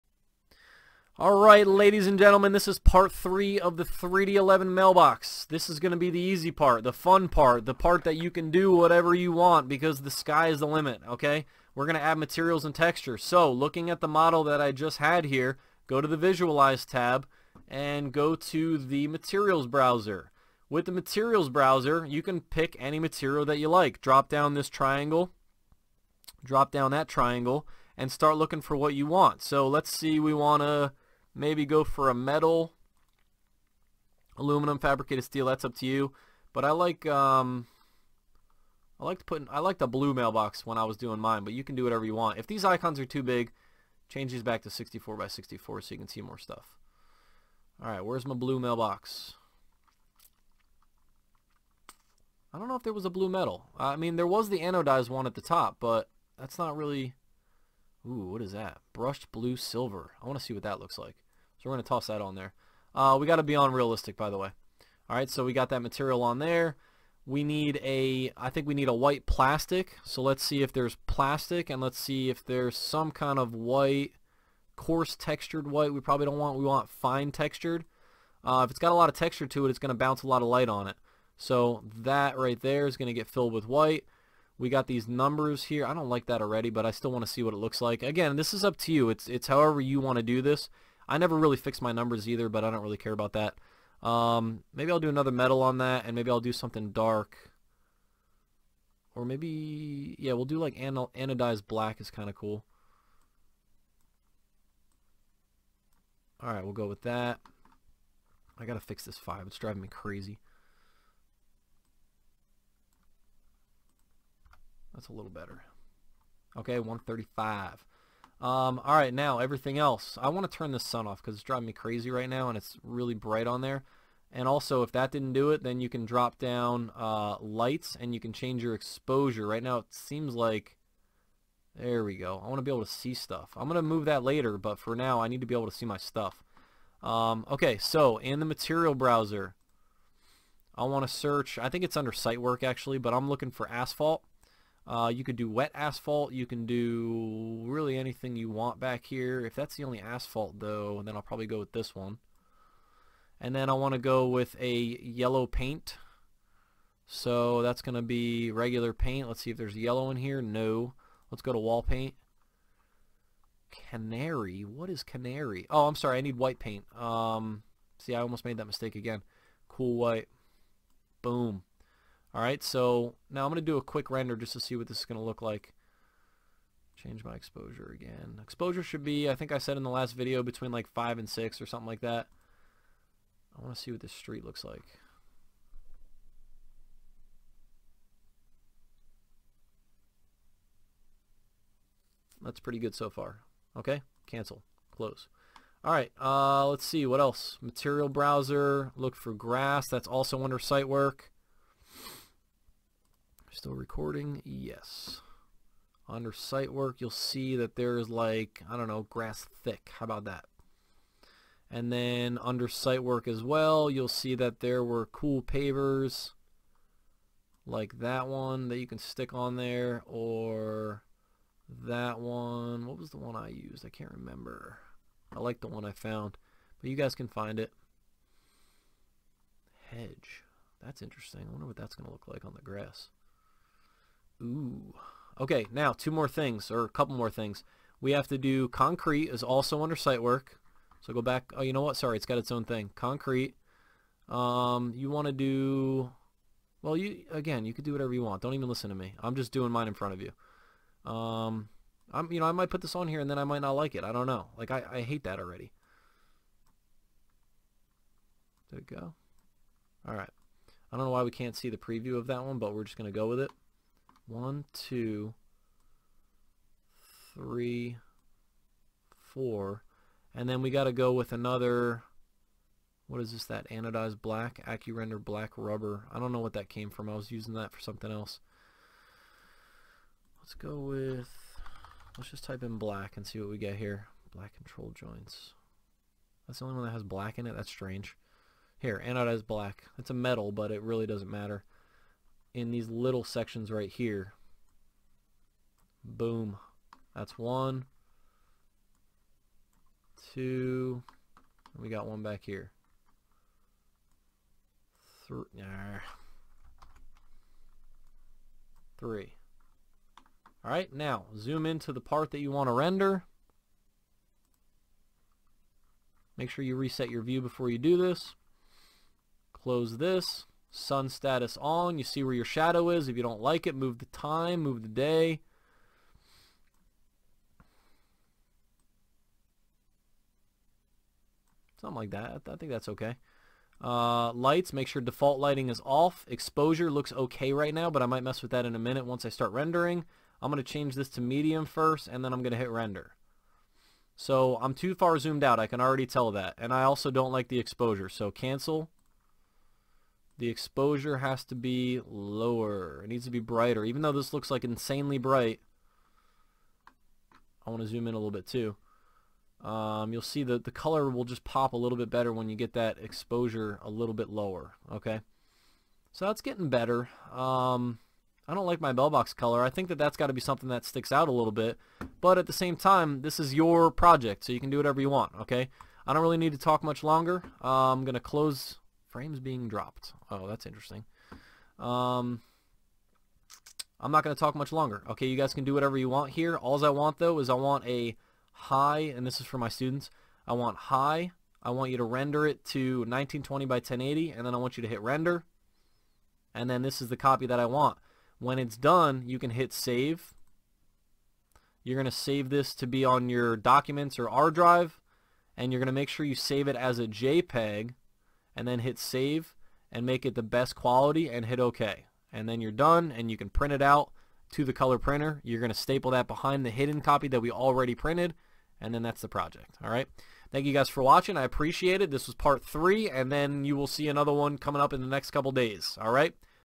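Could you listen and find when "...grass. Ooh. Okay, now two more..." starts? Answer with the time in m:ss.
3:52.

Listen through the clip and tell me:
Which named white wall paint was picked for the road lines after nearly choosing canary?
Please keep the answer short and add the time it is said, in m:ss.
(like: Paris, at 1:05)
Cool white, at 2:49.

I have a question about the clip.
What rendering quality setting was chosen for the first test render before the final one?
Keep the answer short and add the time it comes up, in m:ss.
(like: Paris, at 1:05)
Medium, at 5:41.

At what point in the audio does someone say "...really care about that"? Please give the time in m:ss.
1:32.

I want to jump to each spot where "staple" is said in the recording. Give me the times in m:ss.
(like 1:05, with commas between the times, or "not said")
6:55.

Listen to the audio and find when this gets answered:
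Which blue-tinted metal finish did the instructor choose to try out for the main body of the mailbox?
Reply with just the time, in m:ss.
0:58.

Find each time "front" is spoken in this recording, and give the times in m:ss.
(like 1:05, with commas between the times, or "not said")
4:09.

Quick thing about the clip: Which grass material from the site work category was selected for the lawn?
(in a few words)
Grass thick.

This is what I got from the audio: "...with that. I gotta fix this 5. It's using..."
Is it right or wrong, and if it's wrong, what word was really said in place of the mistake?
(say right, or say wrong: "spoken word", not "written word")
wrong: "driving", not "using".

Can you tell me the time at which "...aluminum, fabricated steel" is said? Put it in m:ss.
0:34.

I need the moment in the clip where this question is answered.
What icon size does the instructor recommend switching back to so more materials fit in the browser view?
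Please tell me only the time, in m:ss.
0:44.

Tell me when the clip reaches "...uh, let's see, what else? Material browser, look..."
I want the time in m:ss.
3:16.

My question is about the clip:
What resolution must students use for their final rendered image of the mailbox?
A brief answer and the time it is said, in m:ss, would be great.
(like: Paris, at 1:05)
1920 by 1080, at 6:32.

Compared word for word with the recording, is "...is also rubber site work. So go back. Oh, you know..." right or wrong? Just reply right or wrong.
wrong.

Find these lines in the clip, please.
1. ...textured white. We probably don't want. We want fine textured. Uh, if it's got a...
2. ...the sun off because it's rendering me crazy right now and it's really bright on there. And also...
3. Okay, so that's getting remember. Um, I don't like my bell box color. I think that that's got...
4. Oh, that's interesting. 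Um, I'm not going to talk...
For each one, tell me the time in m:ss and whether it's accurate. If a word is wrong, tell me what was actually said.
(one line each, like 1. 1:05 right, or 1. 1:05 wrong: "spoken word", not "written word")
1. 1:15 right
2. 2:00 wrong: "driving", not "rendering"
3. 6:04 wrong: "better", not "remember"
4. 6:20 right.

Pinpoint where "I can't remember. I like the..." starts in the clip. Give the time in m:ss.
3:43.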